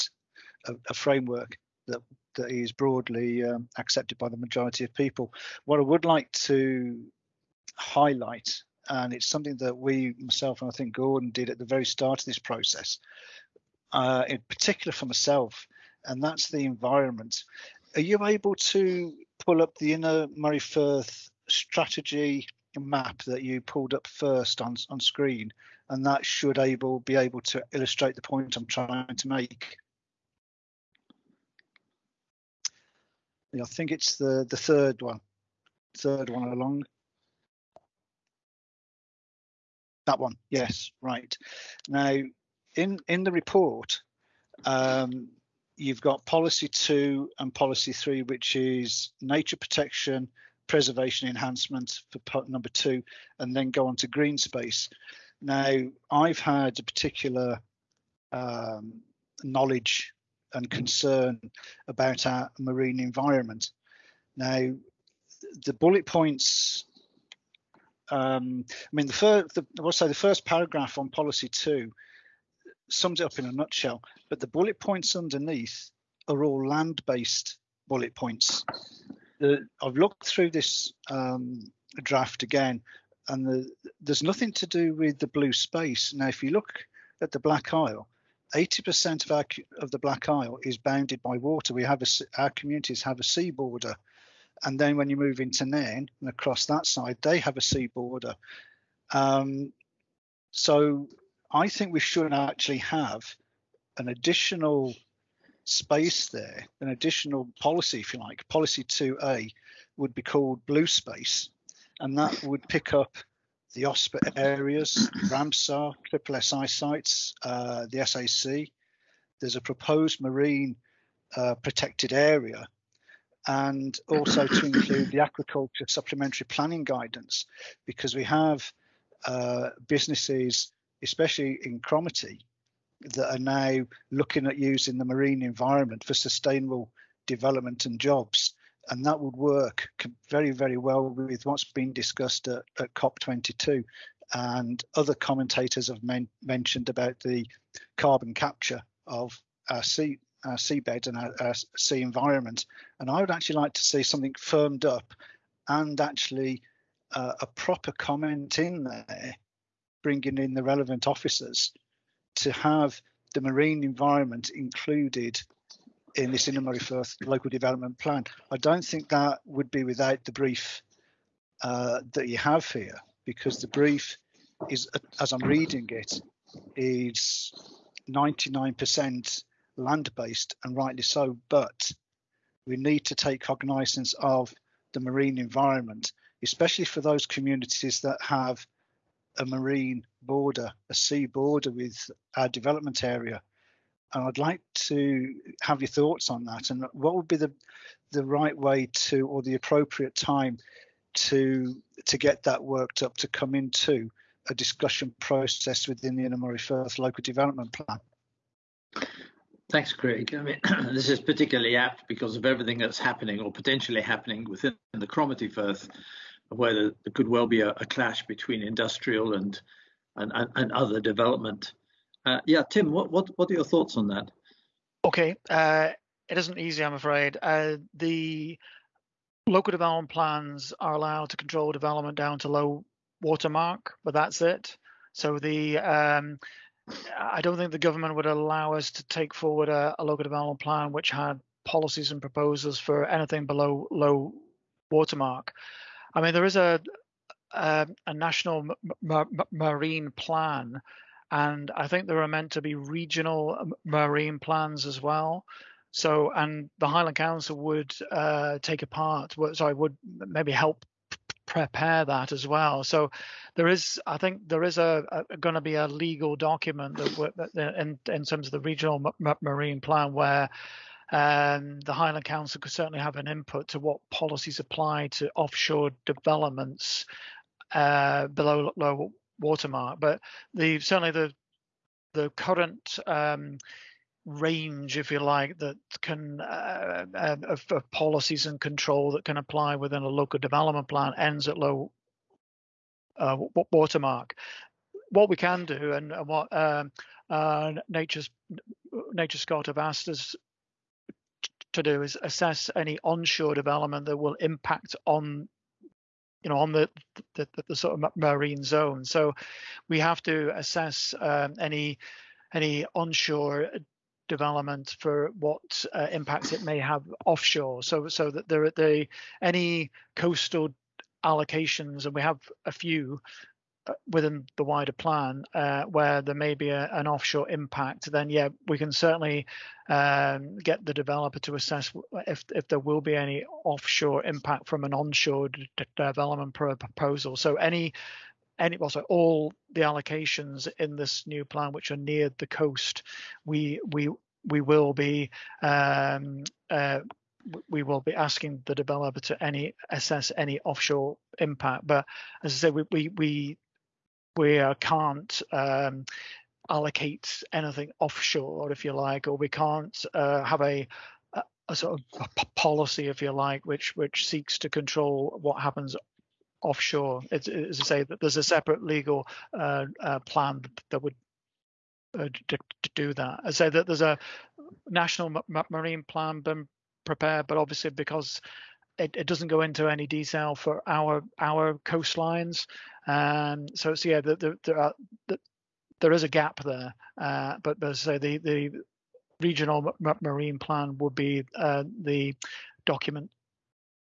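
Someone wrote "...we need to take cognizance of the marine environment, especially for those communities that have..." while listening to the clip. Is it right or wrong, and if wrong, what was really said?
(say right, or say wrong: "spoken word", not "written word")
right.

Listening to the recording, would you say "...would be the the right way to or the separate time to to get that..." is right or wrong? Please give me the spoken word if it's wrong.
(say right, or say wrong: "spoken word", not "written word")
wrong: "appropriate", not "separate".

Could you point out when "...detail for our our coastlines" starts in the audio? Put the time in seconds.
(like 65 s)
380 s.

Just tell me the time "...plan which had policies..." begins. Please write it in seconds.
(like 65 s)
240 s.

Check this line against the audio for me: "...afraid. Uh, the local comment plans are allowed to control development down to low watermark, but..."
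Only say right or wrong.
wrong.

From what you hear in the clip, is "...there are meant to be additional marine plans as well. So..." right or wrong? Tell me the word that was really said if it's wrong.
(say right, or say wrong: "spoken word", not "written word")
wrong: "regional", not "additional".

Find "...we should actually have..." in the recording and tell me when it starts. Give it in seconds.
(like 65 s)
101 s.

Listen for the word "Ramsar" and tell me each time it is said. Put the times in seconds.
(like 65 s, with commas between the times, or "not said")
115 s.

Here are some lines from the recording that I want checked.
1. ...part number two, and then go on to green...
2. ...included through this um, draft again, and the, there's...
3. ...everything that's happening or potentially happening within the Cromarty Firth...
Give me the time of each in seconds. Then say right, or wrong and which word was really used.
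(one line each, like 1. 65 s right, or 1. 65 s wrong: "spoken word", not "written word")
1. 52 s right
2. 79 s wrong: "looked", not "included"
3. 212 s right.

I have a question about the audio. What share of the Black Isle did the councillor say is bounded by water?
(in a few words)
80%.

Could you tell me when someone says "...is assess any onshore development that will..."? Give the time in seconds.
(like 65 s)
302 s.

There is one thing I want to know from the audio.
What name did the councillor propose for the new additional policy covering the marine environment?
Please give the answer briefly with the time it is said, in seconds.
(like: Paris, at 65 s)
Policy 2A, at 108 s.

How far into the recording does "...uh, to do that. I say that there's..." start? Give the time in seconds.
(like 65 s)
372 s.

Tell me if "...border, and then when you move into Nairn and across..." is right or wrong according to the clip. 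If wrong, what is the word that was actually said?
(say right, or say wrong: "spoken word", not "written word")
right.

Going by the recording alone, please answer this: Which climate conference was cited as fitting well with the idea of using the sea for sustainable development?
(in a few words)
COP22.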